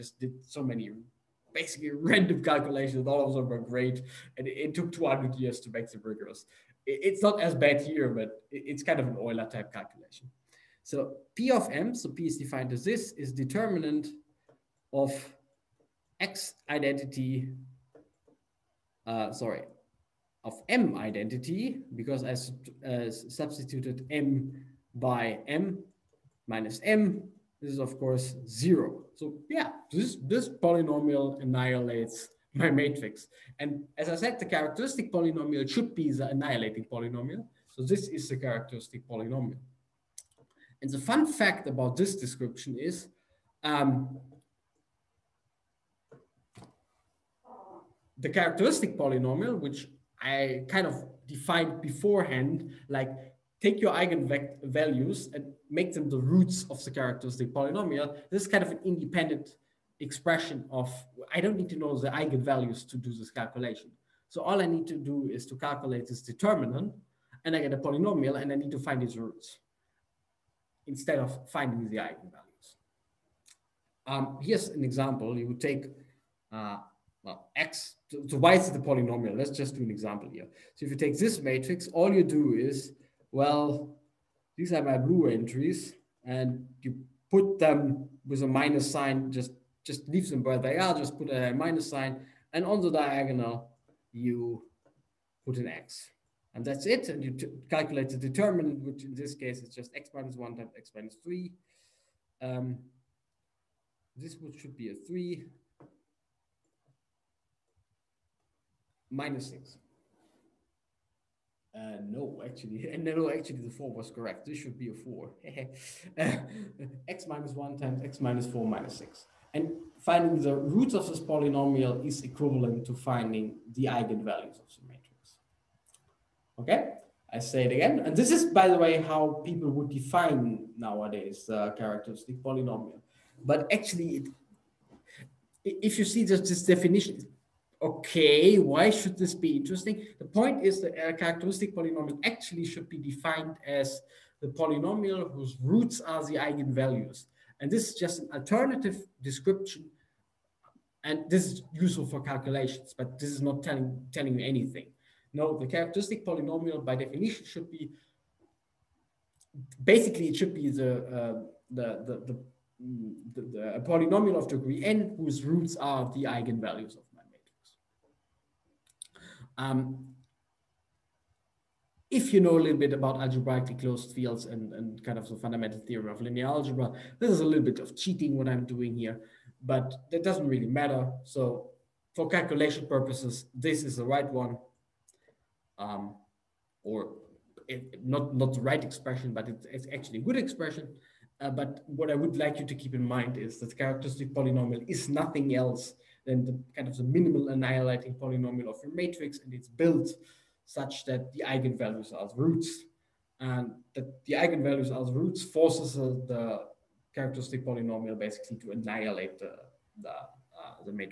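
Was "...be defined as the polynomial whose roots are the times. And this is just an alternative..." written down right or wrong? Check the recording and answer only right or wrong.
wrong.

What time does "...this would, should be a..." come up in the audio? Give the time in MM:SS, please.
01:44.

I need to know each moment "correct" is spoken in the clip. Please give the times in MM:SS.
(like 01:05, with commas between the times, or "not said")
01:54.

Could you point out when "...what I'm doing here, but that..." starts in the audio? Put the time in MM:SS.
02:58.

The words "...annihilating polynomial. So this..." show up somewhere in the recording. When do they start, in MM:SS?
00:36.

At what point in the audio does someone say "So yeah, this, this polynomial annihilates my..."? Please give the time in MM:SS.
00:29.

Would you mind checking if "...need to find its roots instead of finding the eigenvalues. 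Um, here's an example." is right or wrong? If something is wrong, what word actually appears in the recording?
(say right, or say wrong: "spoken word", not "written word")
right.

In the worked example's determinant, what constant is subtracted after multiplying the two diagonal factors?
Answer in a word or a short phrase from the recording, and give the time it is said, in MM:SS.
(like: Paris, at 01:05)
6, at 01:58.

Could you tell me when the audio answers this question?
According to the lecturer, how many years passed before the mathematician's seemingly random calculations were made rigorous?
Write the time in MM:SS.
00:04.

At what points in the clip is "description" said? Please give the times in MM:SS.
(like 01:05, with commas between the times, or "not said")
00:42, 02:29.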